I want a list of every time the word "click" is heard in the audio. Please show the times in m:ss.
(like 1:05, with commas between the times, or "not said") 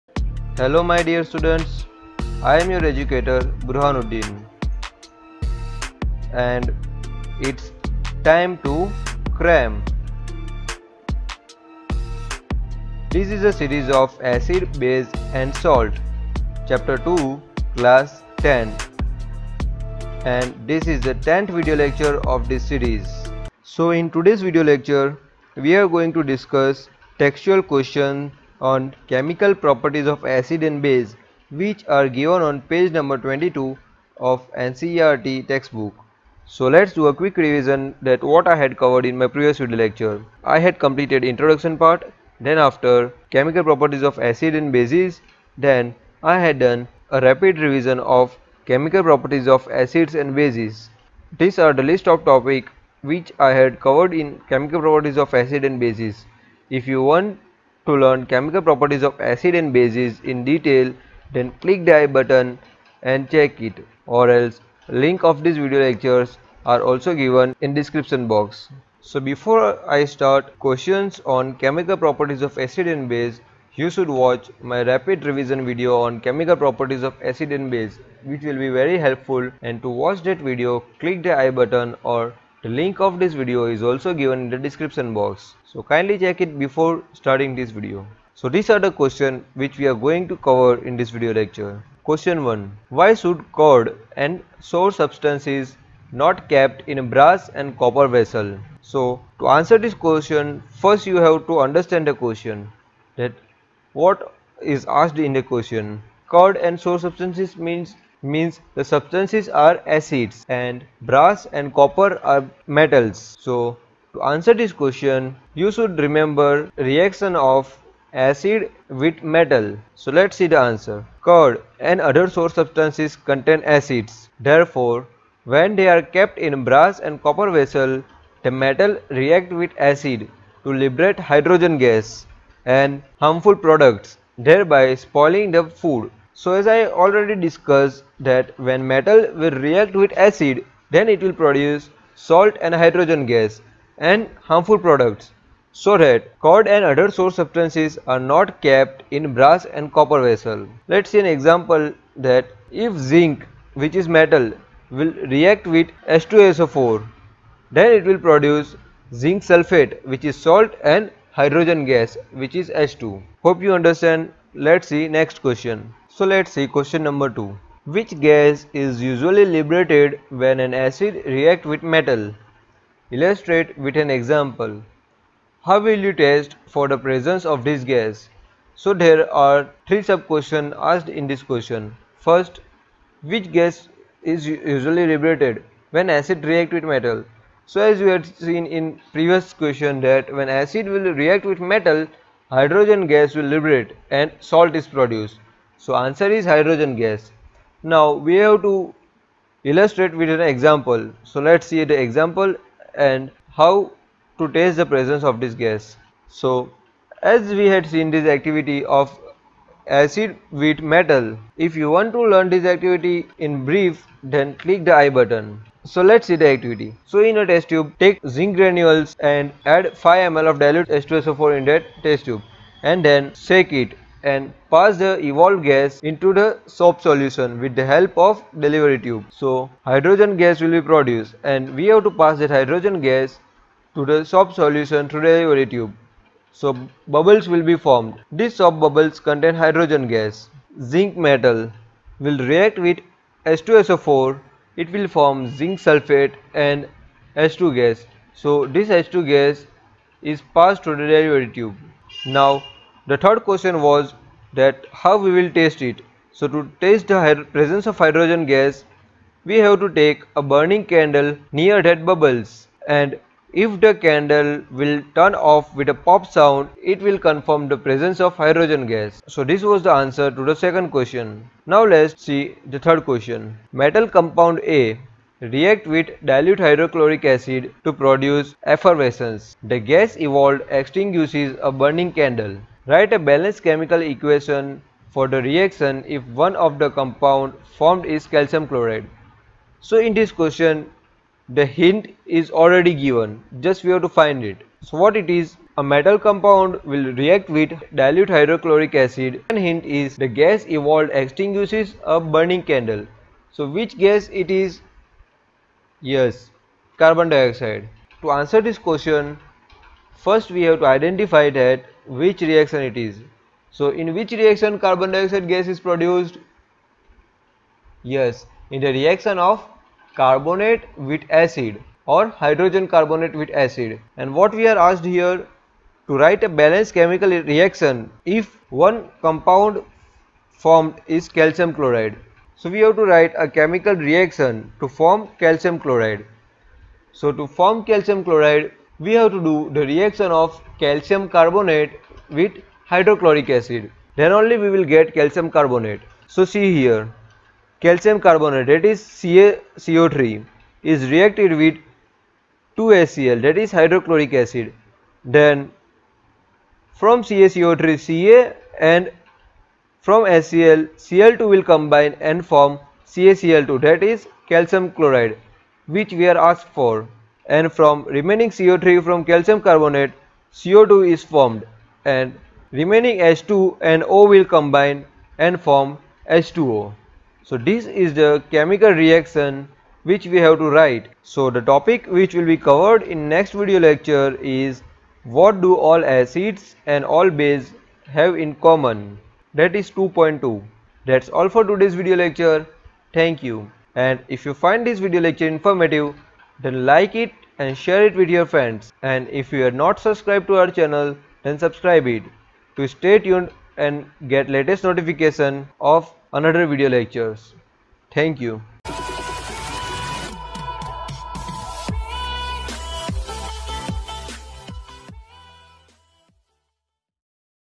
1:01, 1:20, 3:34.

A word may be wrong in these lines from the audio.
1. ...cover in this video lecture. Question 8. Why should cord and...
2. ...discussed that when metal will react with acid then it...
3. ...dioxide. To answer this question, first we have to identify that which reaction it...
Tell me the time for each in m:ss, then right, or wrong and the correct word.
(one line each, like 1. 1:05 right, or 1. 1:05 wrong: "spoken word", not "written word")
1. 1:30 wrong: "1", not "8"
2. 2:17 right
3. 5:07 right.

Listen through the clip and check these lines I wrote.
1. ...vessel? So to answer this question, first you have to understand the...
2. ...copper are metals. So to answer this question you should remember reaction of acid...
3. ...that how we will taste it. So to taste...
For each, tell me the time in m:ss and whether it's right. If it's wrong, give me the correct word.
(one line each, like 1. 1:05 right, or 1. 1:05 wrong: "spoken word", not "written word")
1. 1:38 right
2. 1:51 right
3. 4:14 right.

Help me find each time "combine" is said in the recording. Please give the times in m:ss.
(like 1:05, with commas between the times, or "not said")
6:01, 6:14.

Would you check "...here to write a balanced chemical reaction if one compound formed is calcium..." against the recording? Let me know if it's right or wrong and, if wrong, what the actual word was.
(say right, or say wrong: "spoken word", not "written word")
right.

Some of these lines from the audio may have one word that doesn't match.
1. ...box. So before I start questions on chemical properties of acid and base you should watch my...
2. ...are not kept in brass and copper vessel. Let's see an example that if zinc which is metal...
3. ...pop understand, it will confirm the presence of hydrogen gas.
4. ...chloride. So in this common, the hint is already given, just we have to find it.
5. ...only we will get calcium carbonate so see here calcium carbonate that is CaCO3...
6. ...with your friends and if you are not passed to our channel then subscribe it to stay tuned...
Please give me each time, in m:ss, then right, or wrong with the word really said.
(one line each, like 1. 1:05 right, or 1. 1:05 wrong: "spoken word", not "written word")
1. 1:08 right
2. 2:28 right
3. 4:25 wrong: "sound", not "understand"
4. 4:48 wrong: "question", not "common"
5. 5:44 right
6. 6:38 wrong: "subscribed", not "passed".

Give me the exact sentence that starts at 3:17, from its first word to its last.
Now we have to illustrate with an example.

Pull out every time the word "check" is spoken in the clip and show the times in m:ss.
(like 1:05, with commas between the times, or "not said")
1:03, 1:26.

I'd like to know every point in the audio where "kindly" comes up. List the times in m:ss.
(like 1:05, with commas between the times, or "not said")
1:25.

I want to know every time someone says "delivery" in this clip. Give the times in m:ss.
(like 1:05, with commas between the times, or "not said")
3:48, 3:55, 4:11.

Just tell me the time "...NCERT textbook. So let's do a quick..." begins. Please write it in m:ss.
0:34.